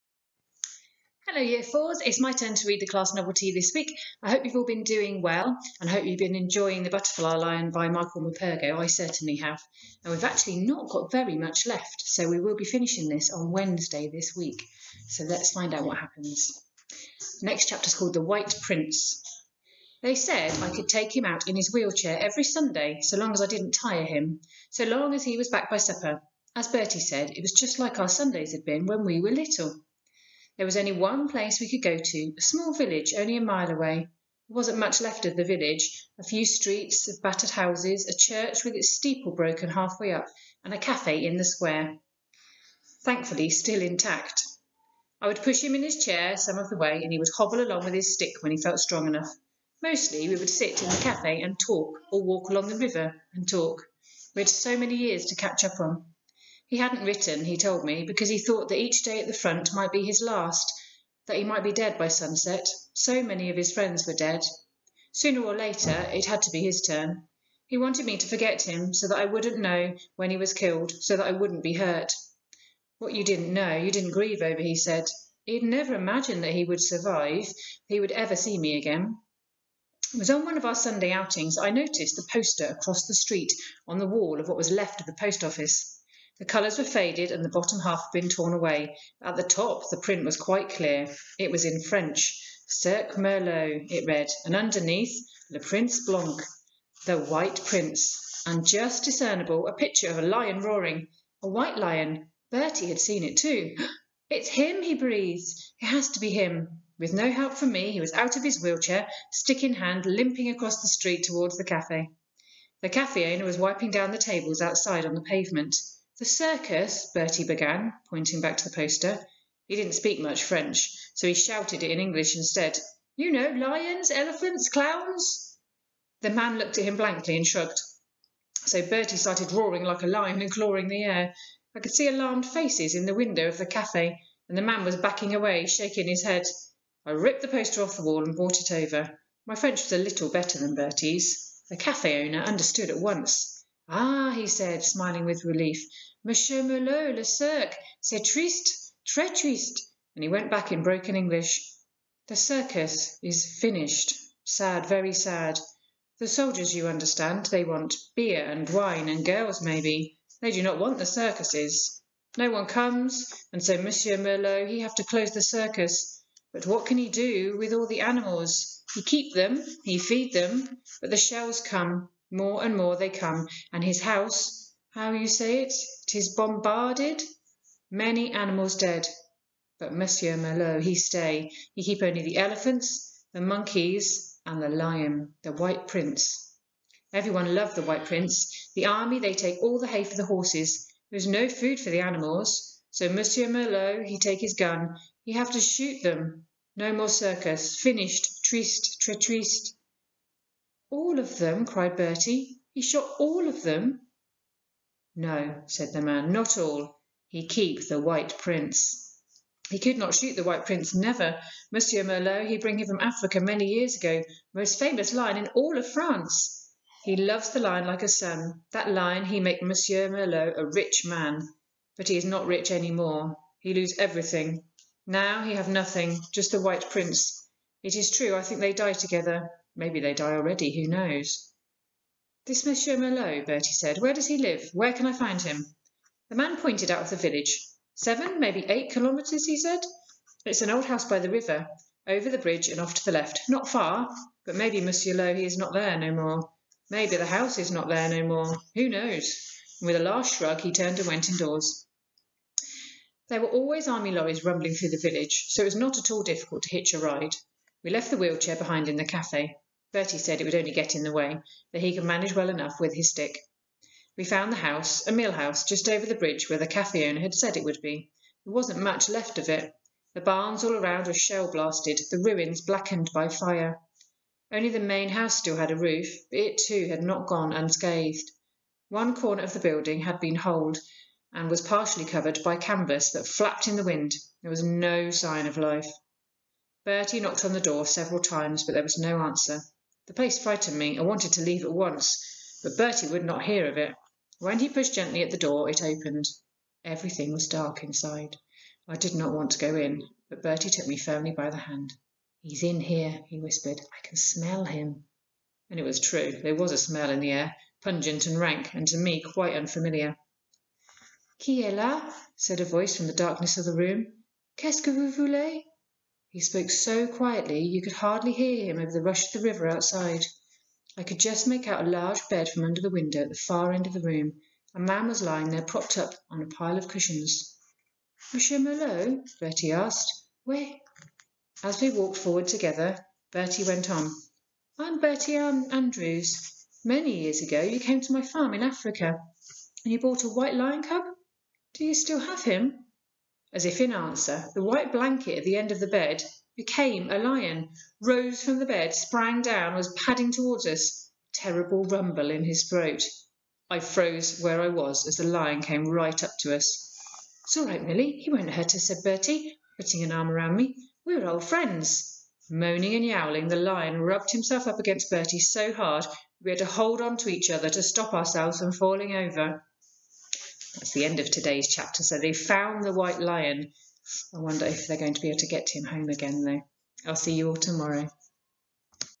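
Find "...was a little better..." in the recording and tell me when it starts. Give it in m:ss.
2:19.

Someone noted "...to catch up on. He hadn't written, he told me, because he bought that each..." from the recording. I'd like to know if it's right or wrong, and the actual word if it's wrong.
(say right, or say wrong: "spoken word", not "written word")
wrong: "thought", not "bought".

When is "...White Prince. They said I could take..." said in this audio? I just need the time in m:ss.
0:18.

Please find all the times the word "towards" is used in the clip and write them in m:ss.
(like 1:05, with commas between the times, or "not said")
1:51, 5:50.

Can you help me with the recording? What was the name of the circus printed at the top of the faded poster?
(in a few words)
Cirque Merlot.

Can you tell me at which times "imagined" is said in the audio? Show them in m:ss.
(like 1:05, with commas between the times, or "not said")
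1:15.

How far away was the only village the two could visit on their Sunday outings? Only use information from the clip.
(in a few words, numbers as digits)
a mile.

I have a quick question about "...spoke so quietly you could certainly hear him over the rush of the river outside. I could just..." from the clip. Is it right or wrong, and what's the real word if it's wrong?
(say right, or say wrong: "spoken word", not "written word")
wrong: "hardly", not "certainly".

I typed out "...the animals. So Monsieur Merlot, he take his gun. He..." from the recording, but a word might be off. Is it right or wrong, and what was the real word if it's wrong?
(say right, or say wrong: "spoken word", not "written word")
right.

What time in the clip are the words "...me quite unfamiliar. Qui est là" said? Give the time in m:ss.
5:08.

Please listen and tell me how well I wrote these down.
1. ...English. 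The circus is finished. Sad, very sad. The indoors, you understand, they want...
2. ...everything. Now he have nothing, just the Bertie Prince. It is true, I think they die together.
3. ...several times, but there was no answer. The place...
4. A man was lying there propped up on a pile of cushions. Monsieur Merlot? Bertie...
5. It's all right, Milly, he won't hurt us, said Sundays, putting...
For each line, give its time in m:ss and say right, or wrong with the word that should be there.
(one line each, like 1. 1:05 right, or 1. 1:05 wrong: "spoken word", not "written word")
1. 2:31 wrong: "soldiers", not "indoors"
2. 3:43 wrong: "White", not "Bertie"
3. 4:47 right
4. 5:24 right
5. 5:57 wrong: "Bertie", not "Sundays".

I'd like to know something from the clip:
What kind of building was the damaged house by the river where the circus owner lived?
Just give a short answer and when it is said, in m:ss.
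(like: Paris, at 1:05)
a mill house, at 4:25.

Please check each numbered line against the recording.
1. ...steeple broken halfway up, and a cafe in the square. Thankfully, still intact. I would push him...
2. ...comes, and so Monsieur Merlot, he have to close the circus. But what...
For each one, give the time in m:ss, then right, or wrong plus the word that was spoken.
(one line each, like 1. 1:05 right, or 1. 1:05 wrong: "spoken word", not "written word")
1. 0:38 right
2. 2:42 right.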